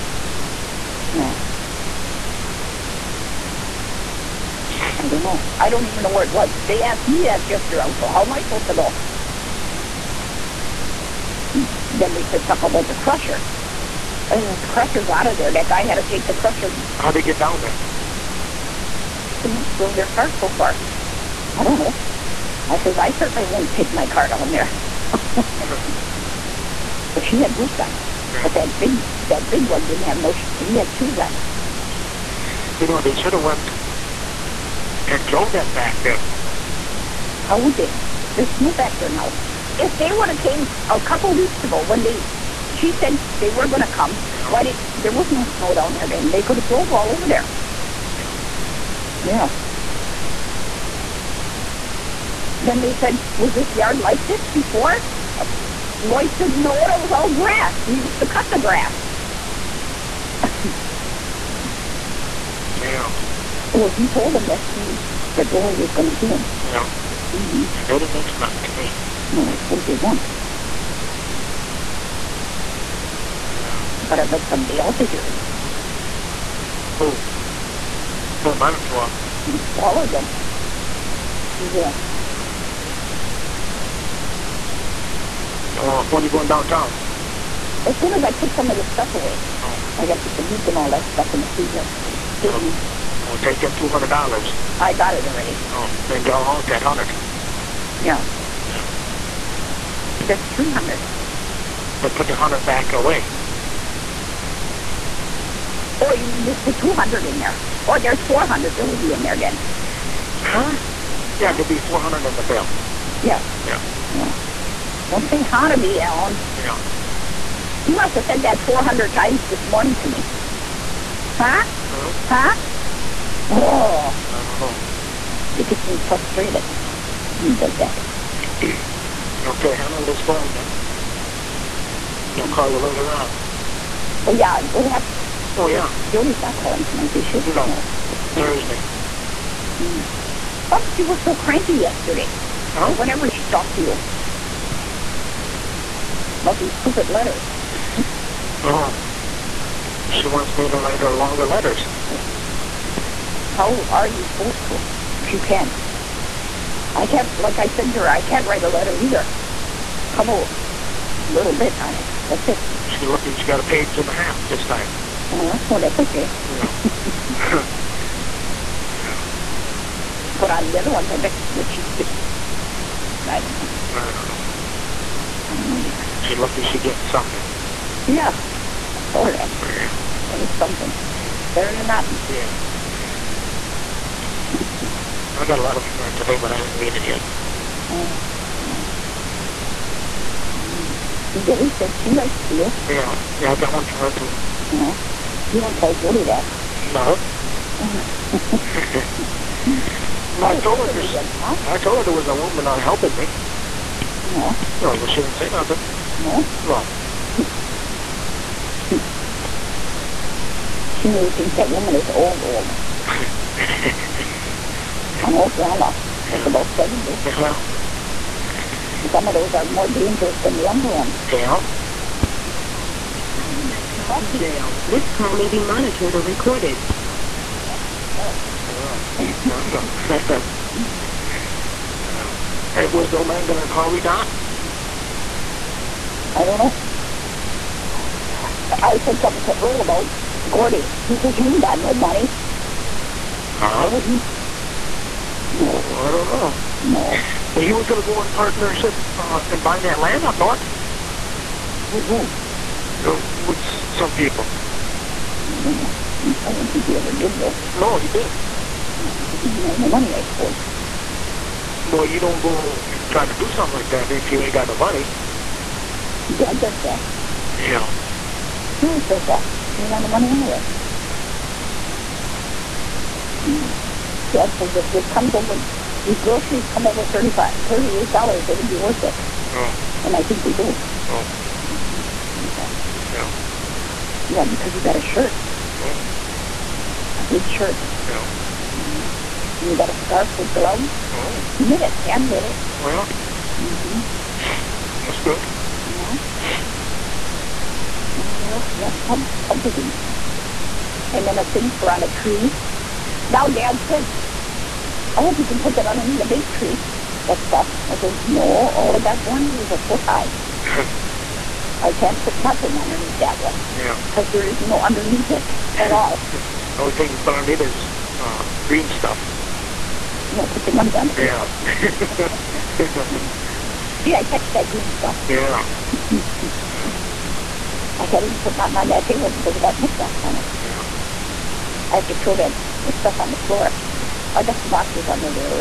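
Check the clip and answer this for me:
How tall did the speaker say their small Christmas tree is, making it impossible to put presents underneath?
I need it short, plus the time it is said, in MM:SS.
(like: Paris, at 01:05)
a foot high, at 05:09.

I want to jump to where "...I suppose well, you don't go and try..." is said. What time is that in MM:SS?
04:20.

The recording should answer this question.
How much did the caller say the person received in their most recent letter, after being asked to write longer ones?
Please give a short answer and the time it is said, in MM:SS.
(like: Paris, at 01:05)
a page and a half, at 02:43.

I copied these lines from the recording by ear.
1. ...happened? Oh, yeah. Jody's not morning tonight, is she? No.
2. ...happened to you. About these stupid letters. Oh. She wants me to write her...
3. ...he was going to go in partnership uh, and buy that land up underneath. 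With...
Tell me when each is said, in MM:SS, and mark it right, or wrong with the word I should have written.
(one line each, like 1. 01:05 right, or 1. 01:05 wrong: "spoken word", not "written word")
1. 02:14 wrong: "calling", not "morning"
2. 02:23 wrong: "talked", not "happened"
3. 04:07 wrong: "north", not "underneath".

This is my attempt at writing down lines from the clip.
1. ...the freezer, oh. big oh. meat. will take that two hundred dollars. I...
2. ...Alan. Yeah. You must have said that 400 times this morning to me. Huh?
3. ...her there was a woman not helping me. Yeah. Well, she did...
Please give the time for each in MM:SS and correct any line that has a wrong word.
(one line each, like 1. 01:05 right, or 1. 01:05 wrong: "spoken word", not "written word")
1. 01:31 right
2. 01:55 right
3. 03:21 right.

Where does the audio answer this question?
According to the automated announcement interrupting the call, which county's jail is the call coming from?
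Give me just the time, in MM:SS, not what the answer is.
03:43.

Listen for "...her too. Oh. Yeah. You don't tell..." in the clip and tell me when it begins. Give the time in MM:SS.
03:13.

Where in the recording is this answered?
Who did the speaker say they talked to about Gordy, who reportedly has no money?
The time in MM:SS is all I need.
03:59.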